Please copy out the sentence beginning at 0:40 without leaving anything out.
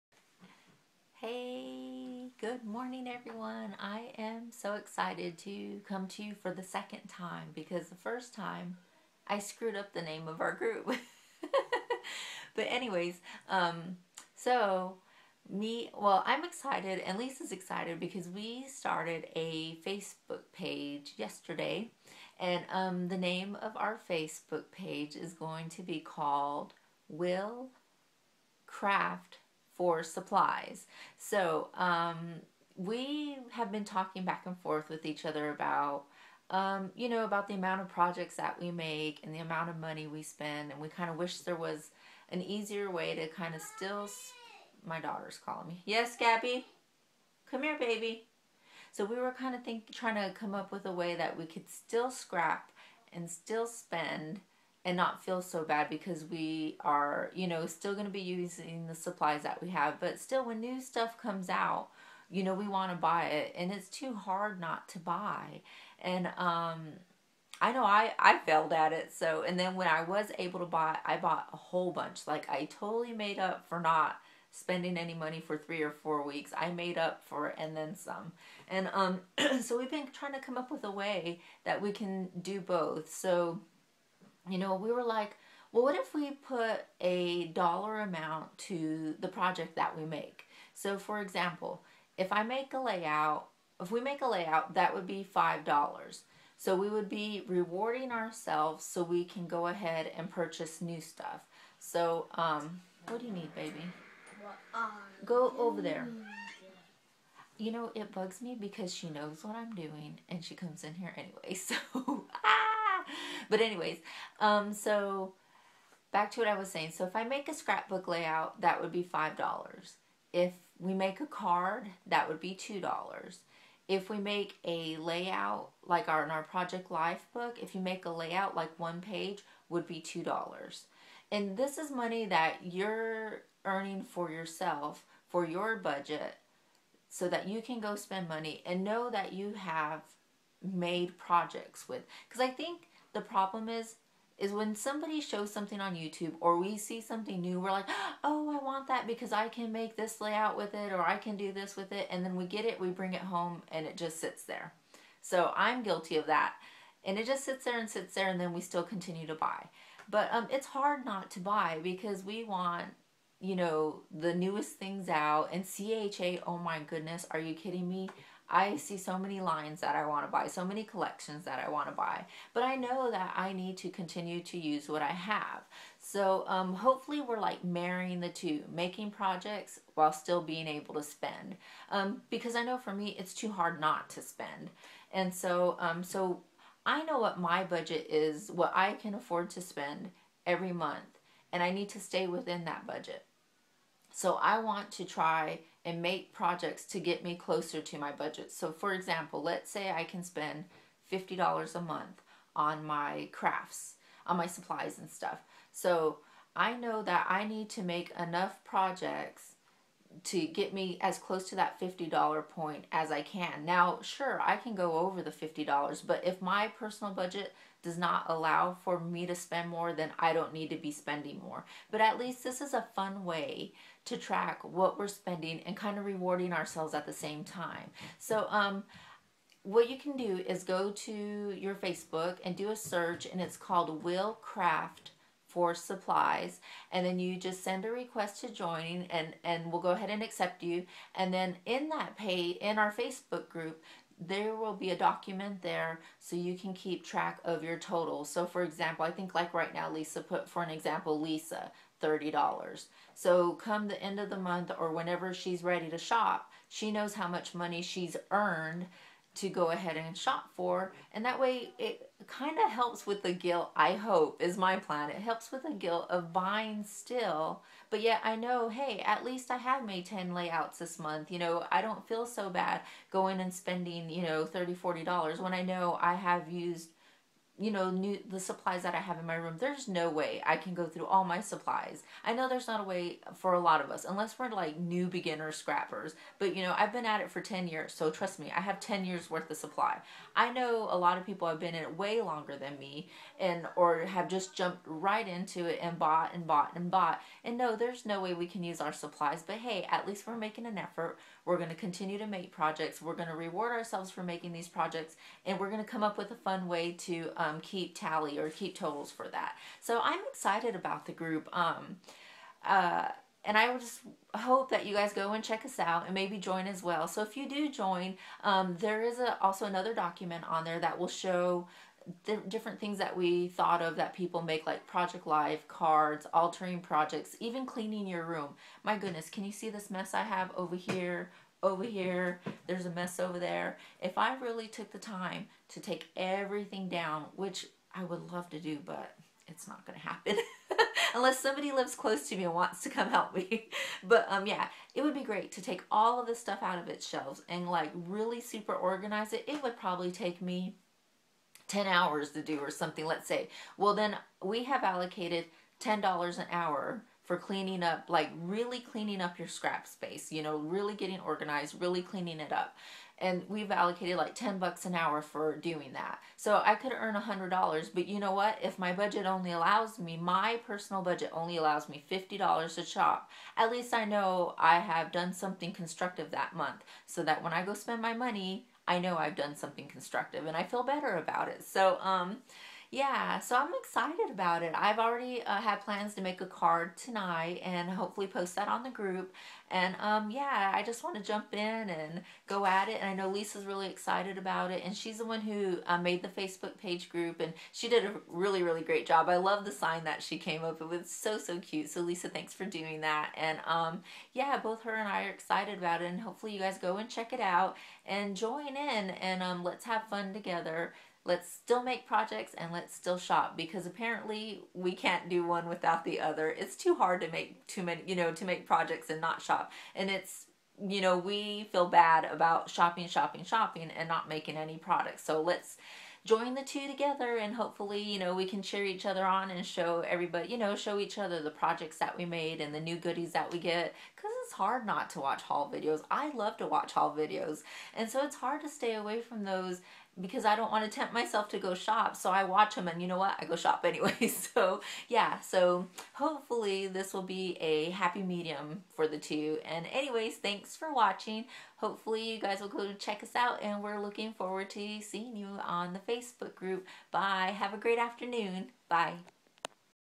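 And we kind of wish there was an easier way to kind of still.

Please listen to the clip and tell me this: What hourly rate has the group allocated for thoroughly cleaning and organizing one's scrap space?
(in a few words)
$10 an hour.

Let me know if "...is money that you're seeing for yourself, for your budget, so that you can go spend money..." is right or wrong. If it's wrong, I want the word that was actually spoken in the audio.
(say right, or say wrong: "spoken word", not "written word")
wrong: "earning", not "seeing".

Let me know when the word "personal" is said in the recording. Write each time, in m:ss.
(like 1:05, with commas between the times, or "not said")
3:36, 6:10.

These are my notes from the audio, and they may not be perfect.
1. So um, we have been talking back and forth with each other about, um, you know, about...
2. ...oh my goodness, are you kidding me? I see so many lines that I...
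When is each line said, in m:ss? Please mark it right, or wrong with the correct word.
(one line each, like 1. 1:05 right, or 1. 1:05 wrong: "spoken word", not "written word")
1. 0:31 right
2. 2:46 right.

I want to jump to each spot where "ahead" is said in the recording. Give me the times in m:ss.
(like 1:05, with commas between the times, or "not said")
1:39, 3:59, 4:19.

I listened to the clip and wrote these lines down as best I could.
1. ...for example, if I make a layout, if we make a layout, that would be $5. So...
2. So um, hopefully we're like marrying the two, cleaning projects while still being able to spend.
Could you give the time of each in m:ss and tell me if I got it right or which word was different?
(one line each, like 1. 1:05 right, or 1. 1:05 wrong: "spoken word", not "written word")
1. 1:30 right
2. 2:55 wrong: "making", not "cleaning".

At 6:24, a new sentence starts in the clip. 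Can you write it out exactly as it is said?
I've already uh, had plans to make a card tonight and hopefully post that on the group.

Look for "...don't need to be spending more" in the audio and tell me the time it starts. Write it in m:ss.
3:40.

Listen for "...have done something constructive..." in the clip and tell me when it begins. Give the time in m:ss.
6:14.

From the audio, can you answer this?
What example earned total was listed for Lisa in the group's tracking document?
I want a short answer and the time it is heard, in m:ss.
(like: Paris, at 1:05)
$30, at 4:11.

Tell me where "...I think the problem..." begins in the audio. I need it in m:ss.
2:22.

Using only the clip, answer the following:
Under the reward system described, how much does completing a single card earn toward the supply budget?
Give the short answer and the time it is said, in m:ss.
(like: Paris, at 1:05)
$2, at 2:00.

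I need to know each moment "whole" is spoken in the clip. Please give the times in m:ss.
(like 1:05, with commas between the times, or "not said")
1:11.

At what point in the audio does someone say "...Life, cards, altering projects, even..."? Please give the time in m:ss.
5:25.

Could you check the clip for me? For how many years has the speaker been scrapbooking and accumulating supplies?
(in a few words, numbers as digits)
10 years.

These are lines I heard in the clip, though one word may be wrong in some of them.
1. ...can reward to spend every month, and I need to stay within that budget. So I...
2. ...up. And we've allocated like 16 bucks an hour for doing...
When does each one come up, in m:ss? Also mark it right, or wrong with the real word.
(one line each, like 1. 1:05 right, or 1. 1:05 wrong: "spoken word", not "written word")
1. 3:08 wrong: "afford", not "reward"
2. 6:02 wrong: "10", not "16".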